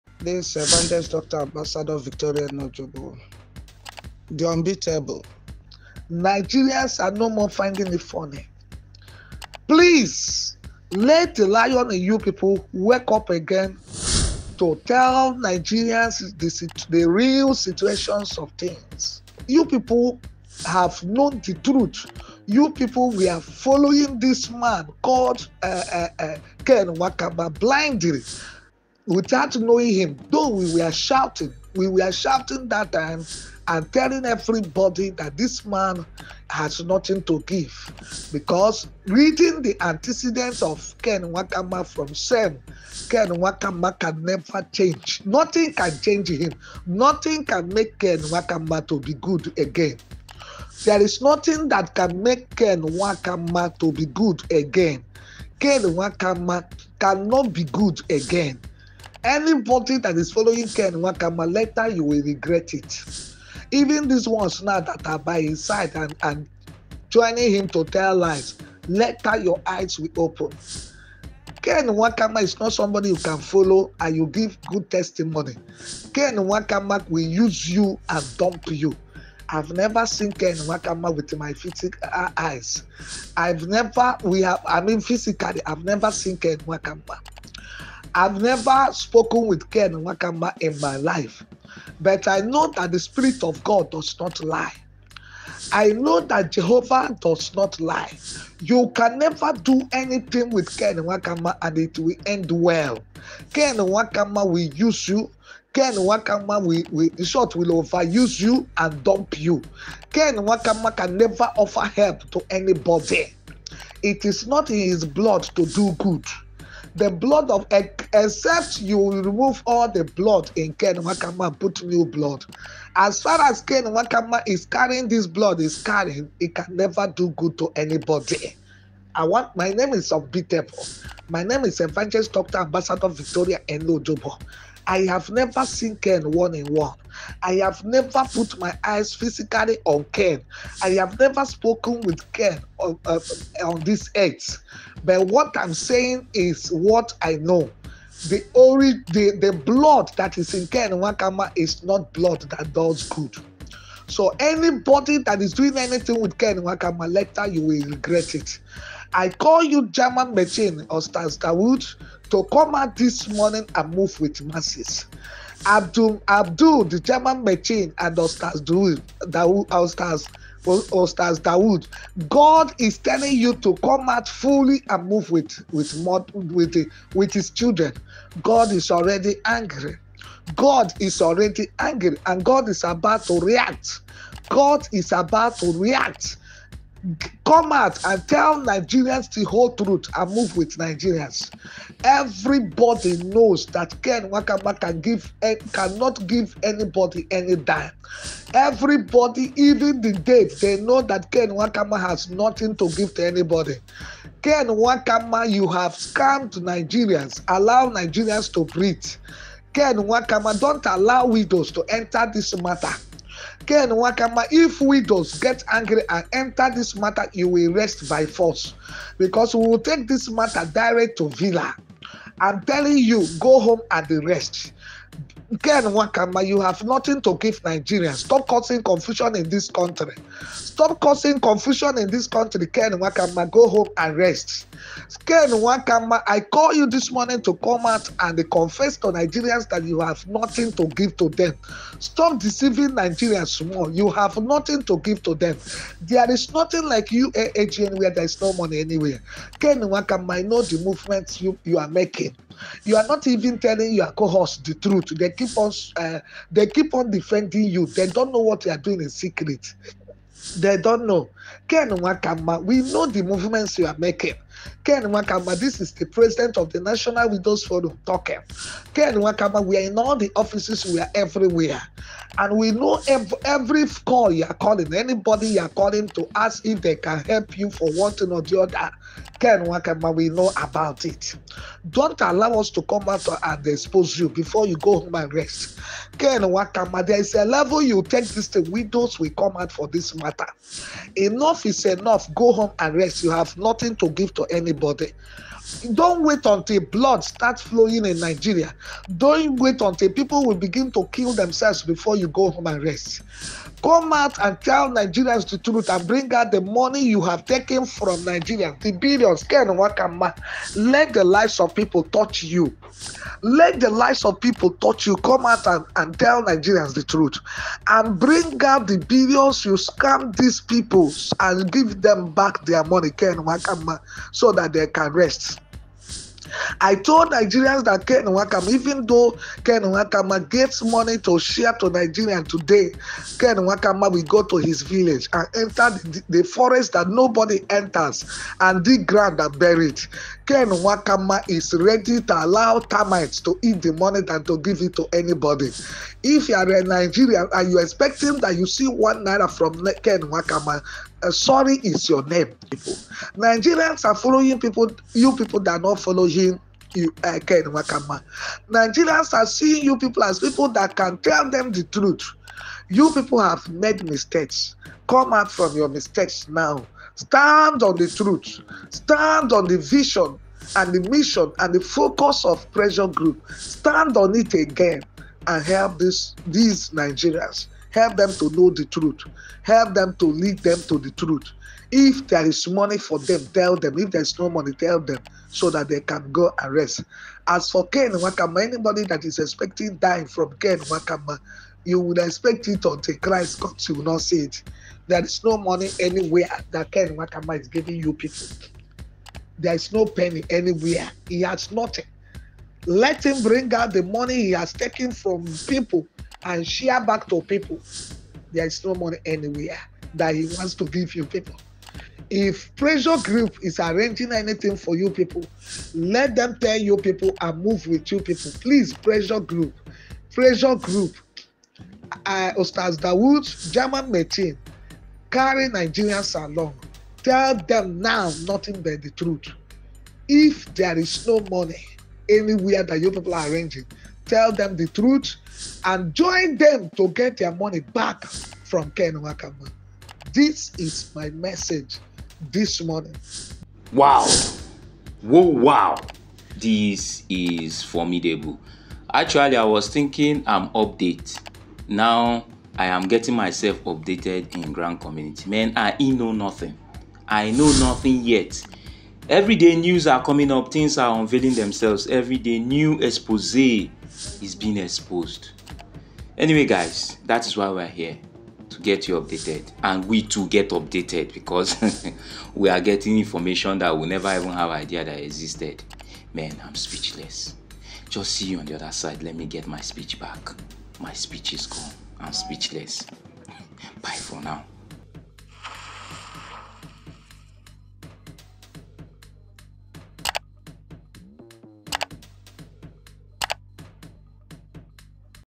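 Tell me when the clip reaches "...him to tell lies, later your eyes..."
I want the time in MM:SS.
01:07.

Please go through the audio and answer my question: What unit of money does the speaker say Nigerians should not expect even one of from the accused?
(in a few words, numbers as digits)
1 naira.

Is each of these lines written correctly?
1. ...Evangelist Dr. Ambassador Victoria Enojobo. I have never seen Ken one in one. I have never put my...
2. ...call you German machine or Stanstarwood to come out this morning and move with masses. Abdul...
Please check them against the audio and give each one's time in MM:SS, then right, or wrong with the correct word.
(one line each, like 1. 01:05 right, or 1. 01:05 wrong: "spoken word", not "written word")
1. 02:11 right
2. 02:39 right.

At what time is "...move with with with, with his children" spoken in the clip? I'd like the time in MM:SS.
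02:55.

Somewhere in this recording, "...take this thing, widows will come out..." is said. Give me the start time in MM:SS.
04:48.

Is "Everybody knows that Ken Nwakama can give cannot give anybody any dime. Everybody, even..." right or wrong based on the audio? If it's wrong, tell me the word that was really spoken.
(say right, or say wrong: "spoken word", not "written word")
right.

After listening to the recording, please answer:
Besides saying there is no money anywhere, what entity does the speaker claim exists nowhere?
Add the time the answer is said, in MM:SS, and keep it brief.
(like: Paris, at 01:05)
UAAG, at 04:07.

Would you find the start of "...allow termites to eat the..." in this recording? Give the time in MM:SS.
05:42.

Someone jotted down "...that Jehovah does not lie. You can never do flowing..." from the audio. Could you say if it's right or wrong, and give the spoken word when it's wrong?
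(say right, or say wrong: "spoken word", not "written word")
wrong: "anything", not "flowing".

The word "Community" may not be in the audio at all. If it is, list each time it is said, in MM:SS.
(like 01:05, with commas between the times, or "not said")
07:35.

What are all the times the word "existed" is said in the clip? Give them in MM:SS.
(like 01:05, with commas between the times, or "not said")
07:55.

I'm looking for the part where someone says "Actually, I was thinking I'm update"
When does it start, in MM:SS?
07:29.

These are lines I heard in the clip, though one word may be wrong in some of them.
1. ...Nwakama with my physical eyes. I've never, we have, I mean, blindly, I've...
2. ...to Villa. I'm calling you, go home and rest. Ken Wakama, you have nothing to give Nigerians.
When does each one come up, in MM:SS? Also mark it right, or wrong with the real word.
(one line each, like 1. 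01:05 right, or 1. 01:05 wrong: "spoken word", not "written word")
1. 01:20 wrong: "physically", not "blindly"
2. 03:41 wrong: "telling", not "calling".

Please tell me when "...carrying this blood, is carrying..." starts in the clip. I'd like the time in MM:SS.
02:04.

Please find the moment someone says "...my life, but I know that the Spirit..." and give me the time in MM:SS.
01:30.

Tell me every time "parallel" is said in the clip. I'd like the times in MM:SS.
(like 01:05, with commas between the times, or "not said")
not said.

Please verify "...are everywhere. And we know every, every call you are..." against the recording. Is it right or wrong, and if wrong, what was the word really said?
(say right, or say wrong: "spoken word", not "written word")
right.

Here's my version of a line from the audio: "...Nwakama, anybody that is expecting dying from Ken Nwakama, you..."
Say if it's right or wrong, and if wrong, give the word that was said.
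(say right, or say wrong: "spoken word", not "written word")
right.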